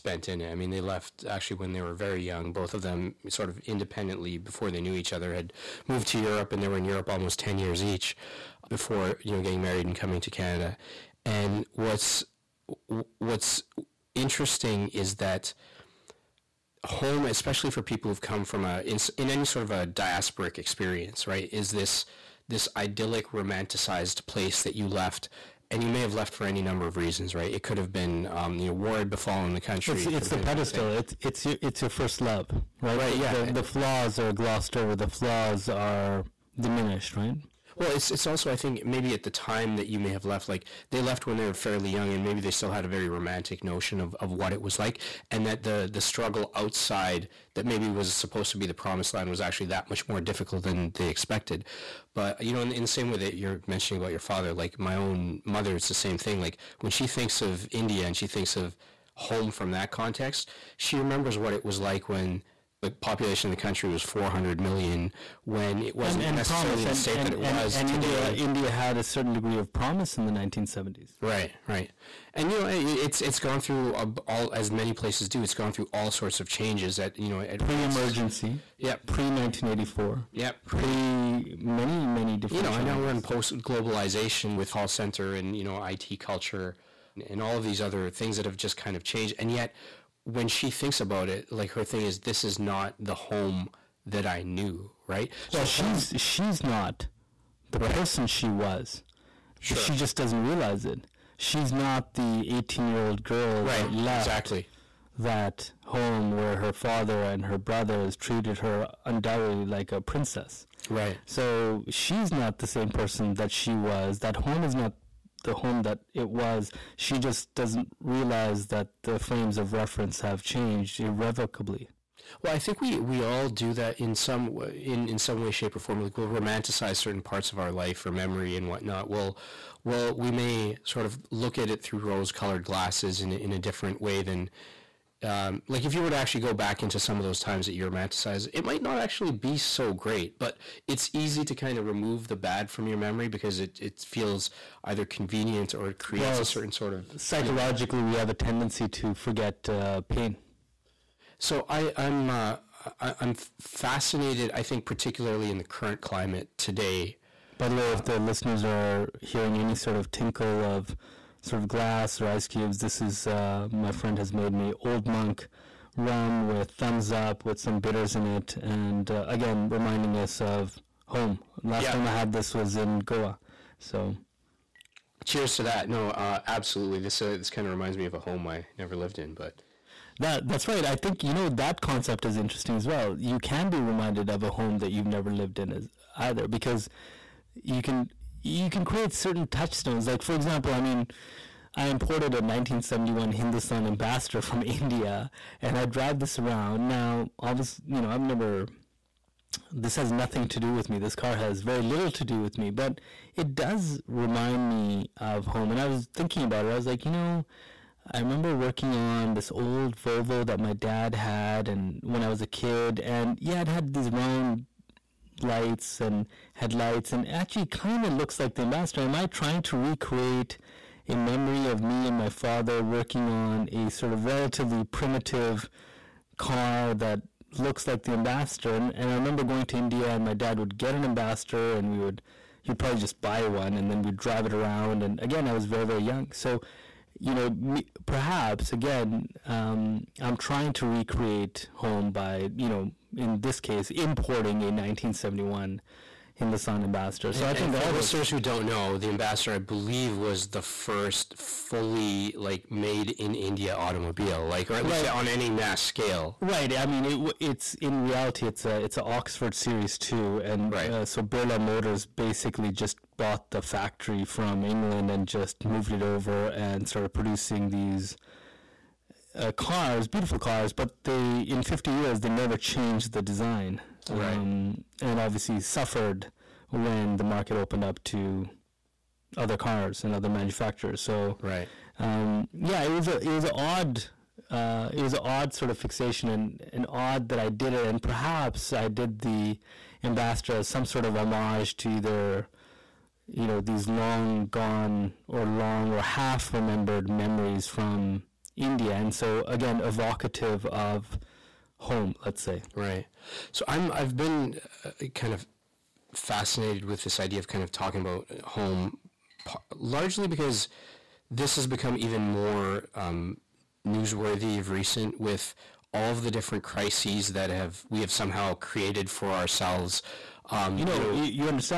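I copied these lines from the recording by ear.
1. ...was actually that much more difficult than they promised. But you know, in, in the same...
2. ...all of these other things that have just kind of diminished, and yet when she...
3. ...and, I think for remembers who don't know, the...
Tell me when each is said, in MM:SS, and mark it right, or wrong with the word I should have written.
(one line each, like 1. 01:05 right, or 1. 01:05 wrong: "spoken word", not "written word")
1. 00:49 wrong: "expected", not "promised"
2. 01:27 wrong: "changed", not "diminished"
3. 04:07 wrong: "listeners", not "remembers".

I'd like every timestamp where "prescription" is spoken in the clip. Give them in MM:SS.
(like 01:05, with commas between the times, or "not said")
not said.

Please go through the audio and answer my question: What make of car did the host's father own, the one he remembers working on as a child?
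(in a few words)
Volvo.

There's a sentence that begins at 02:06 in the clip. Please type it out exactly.
Like we'll romanticize certain parts of our life or memory and whatnot.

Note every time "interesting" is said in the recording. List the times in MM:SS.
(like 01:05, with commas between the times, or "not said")
00:14, 03:02.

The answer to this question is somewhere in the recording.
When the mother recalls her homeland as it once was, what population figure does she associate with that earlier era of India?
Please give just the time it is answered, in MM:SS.
01:04.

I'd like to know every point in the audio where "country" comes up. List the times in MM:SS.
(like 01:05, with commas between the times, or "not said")
00:29, 01:03.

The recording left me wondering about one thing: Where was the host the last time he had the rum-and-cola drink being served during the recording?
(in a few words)
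Goa.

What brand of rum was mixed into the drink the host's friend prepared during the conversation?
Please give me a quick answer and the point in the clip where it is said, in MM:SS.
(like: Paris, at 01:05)
Old Monk, at 02:44.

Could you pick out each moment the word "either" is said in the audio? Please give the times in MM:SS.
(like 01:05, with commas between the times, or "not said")
02:24, 03:06, 04:51.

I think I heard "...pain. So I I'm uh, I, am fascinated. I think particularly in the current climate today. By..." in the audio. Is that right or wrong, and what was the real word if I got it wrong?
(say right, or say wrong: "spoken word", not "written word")
right.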